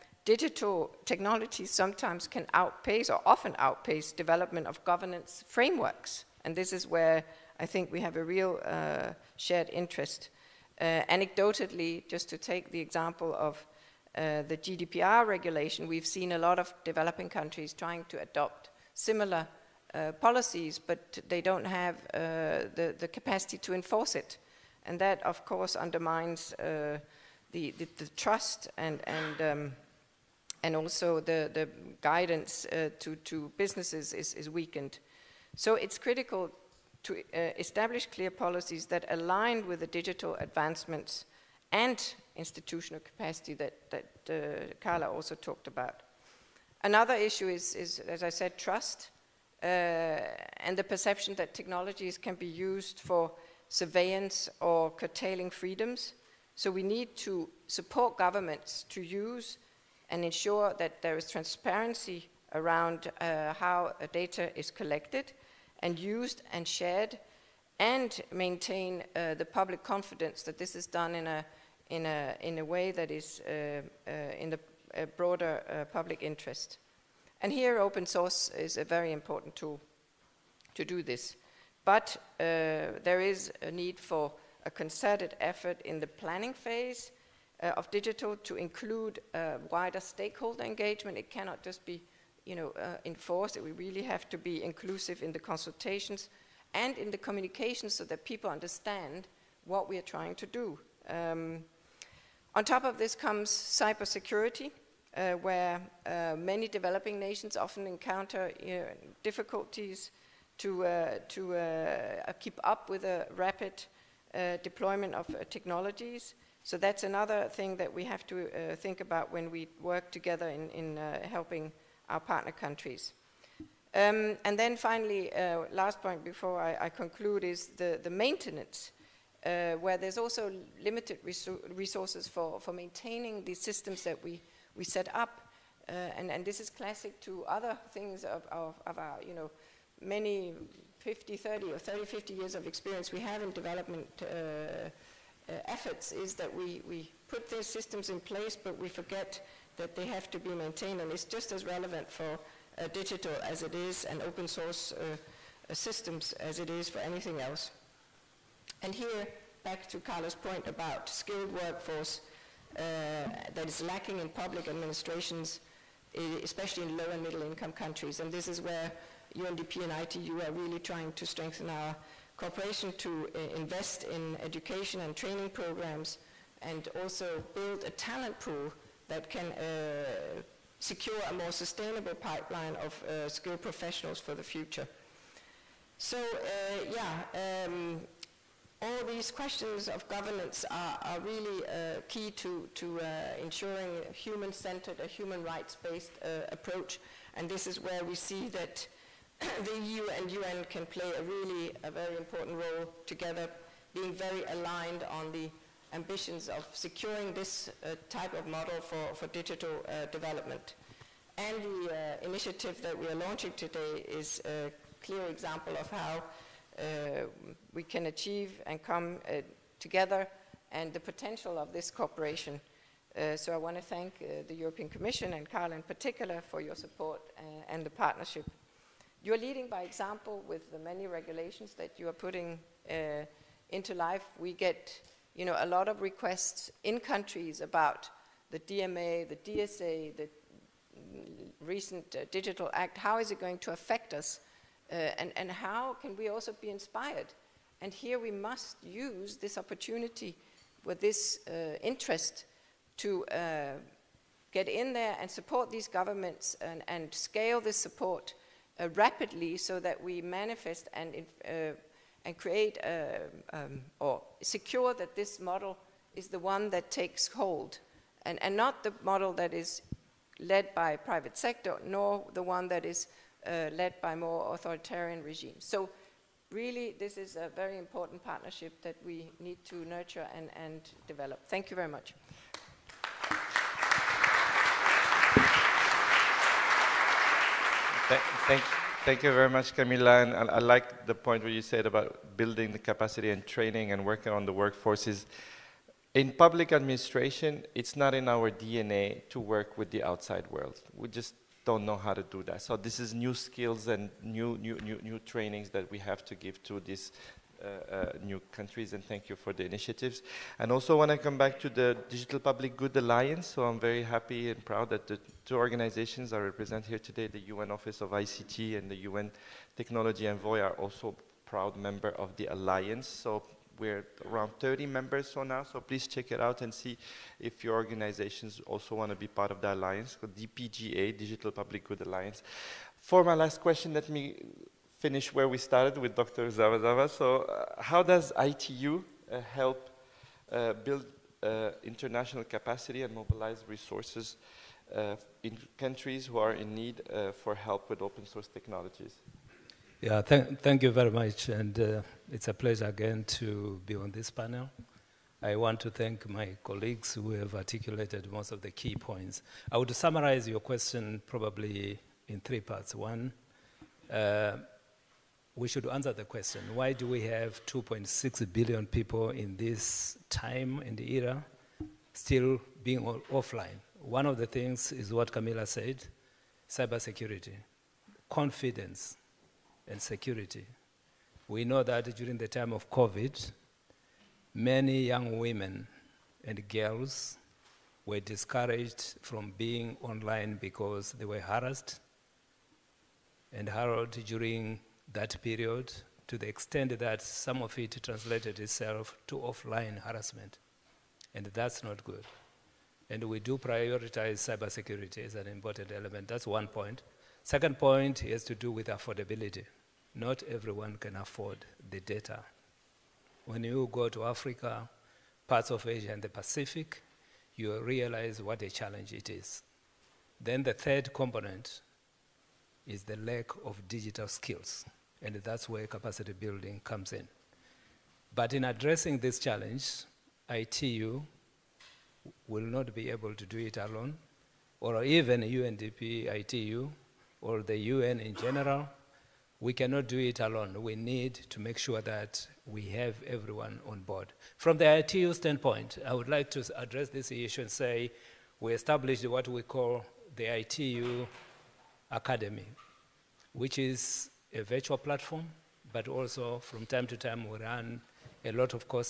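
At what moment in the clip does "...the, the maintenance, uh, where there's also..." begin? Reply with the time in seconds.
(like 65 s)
127 s.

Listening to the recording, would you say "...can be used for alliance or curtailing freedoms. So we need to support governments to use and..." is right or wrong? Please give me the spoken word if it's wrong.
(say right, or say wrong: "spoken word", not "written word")
wrong: "surveillance", not "alliance".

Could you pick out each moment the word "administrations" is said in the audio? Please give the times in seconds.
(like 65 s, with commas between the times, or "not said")
164 s, 296 s.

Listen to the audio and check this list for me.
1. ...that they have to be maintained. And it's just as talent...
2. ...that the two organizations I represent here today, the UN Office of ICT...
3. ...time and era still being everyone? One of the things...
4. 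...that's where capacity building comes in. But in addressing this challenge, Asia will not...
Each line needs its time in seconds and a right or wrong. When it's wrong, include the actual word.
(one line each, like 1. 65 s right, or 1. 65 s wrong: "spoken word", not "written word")
1. 149 s wrong: "relevant", not "talent"
2. 314 s right
3. 370 s wrong: "offline", not "everyone"
4. 425 s wrong: "ITU", not "Asia".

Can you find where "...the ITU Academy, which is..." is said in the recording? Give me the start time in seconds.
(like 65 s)
450 s.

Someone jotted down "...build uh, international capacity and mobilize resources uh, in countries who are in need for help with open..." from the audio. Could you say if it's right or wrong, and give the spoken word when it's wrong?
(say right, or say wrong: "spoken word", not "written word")
right.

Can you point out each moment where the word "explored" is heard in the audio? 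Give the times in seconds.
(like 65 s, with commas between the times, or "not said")
not said.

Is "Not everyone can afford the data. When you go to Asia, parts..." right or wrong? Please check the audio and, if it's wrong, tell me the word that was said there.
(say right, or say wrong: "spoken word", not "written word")
wrong: "Africa", not "Asia".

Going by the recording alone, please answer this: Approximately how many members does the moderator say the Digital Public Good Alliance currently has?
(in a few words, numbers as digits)
30.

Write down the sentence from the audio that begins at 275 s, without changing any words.
So really this is a very important partnership that we need to nurture and, and develop.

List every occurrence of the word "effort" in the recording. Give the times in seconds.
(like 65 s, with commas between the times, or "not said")
85 s, 145 s.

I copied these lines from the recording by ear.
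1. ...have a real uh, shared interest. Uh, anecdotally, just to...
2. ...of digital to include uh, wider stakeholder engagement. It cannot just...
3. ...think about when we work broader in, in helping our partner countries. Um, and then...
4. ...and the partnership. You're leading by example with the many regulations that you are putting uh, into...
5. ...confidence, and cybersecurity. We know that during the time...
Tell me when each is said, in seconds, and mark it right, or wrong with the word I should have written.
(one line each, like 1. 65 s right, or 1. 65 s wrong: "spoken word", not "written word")
1. 8 s right
2. 87 s right
3. 118 s wrong: "together", not "broader"
4. 227 s right
5. 378 s wrong: "security", not "cybersecurity".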